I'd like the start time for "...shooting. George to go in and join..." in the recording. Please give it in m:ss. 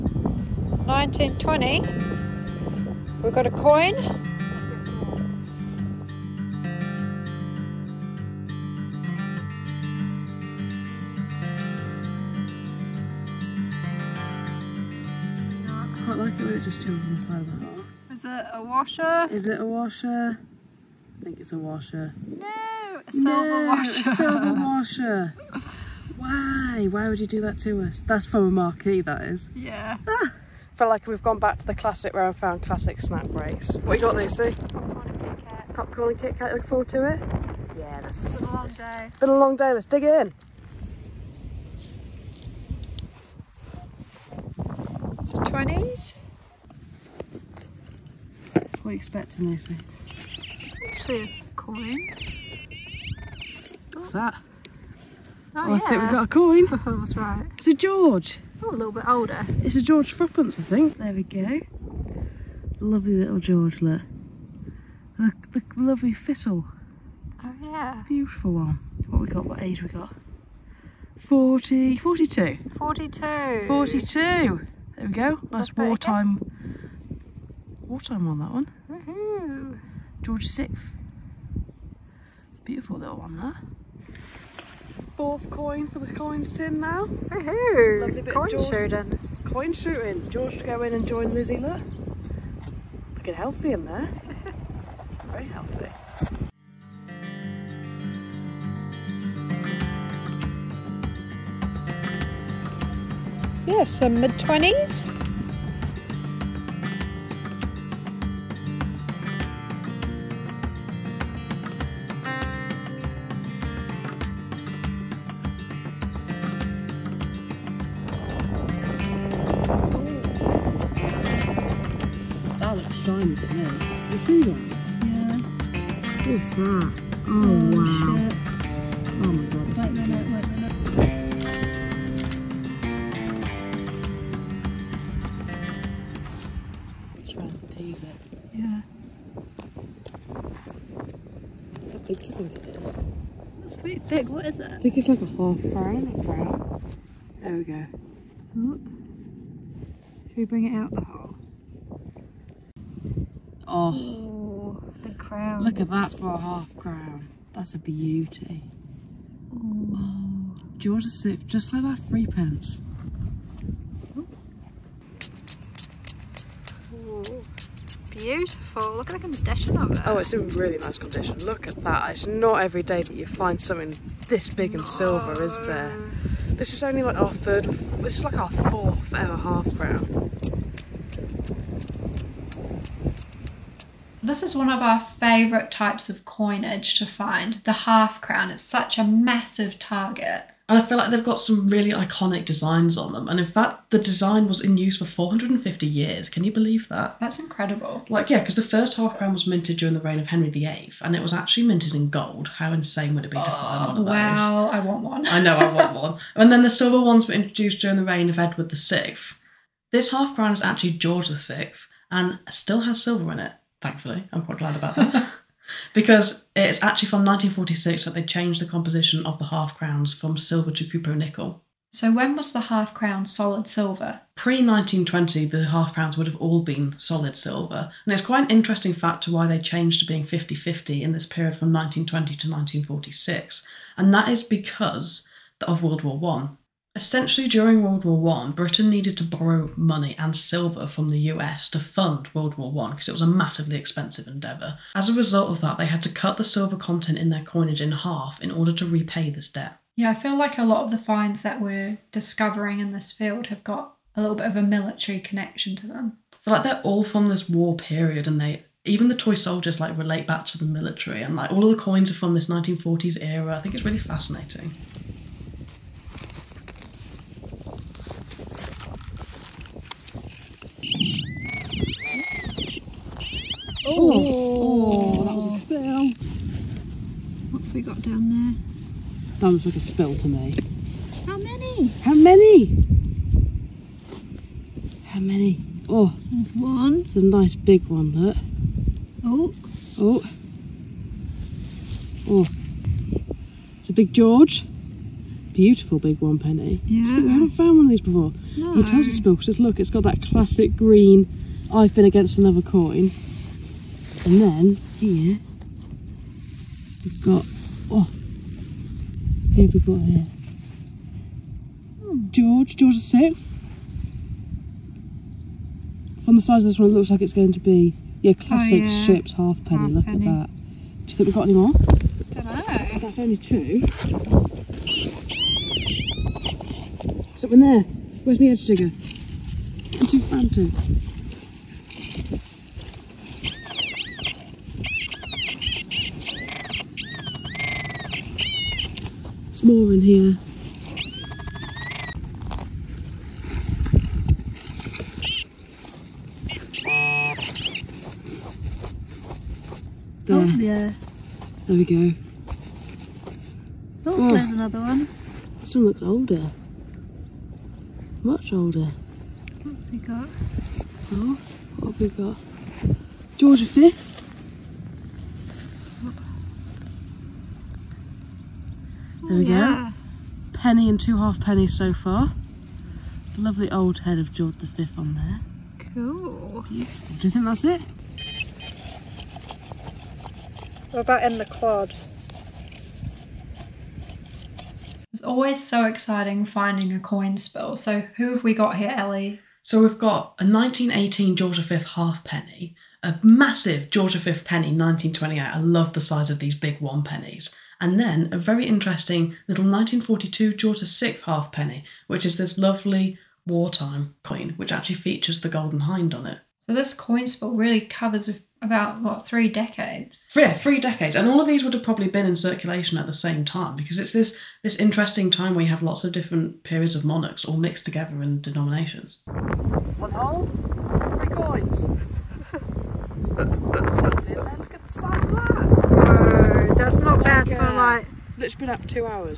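1:29.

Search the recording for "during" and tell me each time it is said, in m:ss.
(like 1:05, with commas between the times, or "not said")
3:19, 3:27, 3:57.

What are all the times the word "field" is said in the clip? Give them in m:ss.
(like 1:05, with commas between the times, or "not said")
4:13.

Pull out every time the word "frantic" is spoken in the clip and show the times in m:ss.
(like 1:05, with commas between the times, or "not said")
5:30.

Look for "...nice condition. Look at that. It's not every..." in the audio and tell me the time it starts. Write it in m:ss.
2:50.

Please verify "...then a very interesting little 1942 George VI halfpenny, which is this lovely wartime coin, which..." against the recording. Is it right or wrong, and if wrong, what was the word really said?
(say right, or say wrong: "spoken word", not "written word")
right.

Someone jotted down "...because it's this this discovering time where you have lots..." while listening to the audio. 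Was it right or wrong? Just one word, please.
wrong.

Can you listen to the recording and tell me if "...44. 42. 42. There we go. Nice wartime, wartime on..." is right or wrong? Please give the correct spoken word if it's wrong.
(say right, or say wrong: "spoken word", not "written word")
wrong: "42", not "44".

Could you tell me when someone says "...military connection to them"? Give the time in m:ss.
4:14.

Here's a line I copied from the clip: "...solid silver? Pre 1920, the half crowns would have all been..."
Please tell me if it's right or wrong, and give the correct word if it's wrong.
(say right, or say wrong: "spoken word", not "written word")
right.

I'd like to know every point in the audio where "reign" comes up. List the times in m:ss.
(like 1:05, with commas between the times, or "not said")
3:20, 3:28.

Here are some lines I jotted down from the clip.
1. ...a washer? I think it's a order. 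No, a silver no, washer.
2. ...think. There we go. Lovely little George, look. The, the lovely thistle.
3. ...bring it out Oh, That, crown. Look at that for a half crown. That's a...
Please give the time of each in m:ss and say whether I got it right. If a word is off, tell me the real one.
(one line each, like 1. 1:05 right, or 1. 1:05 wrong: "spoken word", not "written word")
1. 0:19 wrong: "washer", not "order"
2. 1:00 right
3. 2:30 wrong: "Ooh", not "That".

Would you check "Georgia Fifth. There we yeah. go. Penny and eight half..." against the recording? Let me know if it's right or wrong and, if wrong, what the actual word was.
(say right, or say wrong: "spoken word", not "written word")
wrong: "two", not "eight".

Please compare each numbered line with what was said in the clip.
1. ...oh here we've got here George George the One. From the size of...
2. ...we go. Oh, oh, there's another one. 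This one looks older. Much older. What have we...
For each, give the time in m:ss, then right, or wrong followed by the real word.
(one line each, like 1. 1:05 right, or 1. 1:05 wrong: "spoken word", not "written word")
1. 5:07 wrong: "Sixth", not "One"
2. 5:51 right.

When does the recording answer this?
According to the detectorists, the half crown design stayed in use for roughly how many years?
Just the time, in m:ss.
3:15.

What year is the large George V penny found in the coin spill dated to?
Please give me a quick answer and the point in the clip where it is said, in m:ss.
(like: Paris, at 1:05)
1928, at 6:34.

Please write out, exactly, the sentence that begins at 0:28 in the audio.
That's from a marquee, that is.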